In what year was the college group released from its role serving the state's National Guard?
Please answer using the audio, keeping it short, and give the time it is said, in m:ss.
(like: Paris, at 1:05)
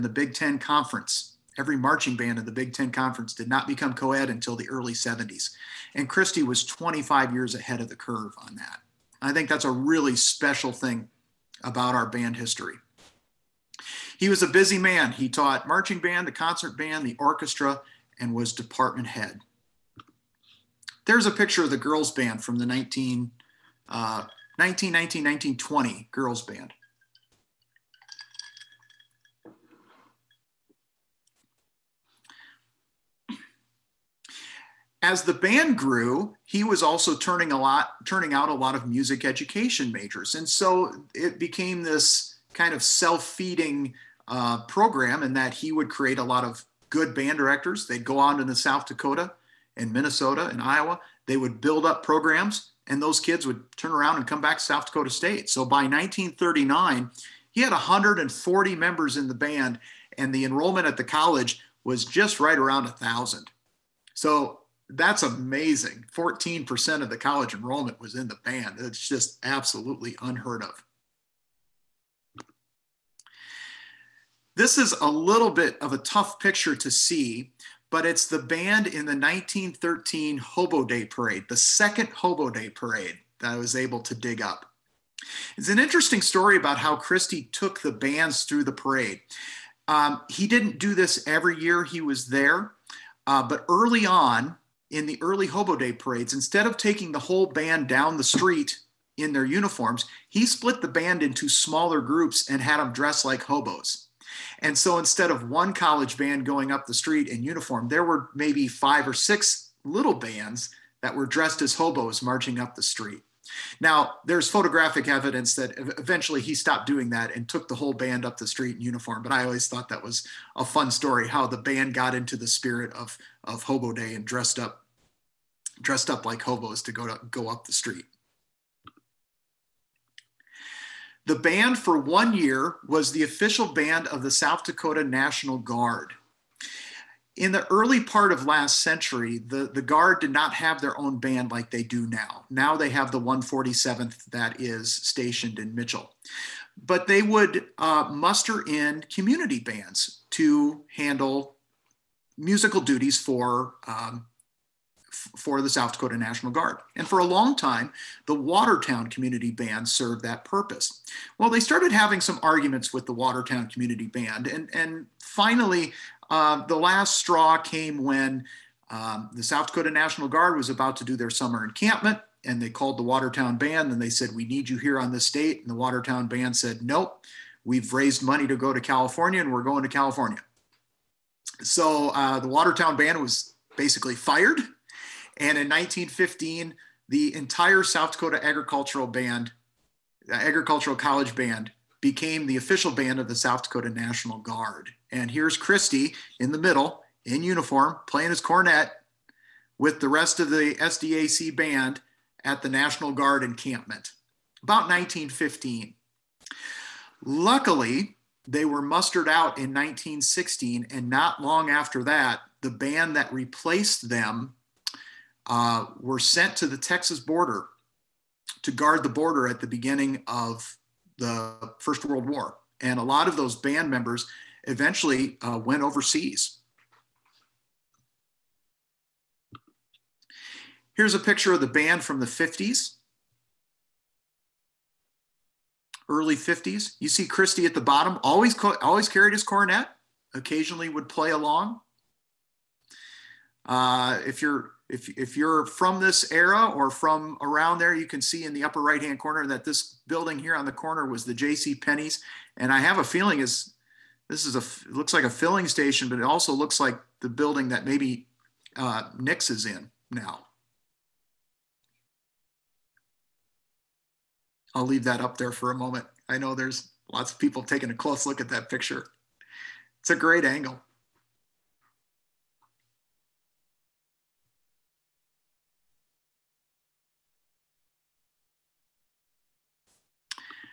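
1916, at 3:29.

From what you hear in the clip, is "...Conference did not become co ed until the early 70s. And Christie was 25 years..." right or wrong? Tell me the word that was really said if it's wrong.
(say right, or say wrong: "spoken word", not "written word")
right.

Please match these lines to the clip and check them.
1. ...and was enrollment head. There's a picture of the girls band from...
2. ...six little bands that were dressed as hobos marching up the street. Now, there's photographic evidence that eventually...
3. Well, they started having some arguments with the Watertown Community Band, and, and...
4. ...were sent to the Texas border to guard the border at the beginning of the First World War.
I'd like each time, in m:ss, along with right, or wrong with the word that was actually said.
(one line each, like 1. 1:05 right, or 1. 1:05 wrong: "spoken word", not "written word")
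1. 0:18 wrong: "department", not "enrollment"
2. 1:49 right
3. 2:41 right
4. 3:35 right.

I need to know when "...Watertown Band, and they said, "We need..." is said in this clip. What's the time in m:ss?
2:53.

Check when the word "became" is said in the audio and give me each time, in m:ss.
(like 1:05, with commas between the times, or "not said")
0:41, 3:11.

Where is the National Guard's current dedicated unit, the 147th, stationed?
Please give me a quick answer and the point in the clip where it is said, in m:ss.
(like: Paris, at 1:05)
Mitchell, at 2:25.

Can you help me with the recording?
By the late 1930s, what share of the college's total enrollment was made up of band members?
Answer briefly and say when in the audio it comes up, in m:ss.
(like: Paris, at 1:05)
14%, at 1:06.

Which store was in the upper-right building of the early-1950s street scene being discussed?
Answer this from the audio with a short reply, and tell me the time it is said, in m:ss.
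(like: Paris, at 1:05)
J.C. Penney's, at 4:11.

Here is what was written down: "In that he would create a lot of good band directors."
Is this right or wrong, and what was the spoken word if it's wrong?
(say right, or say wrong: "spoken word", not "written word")
right.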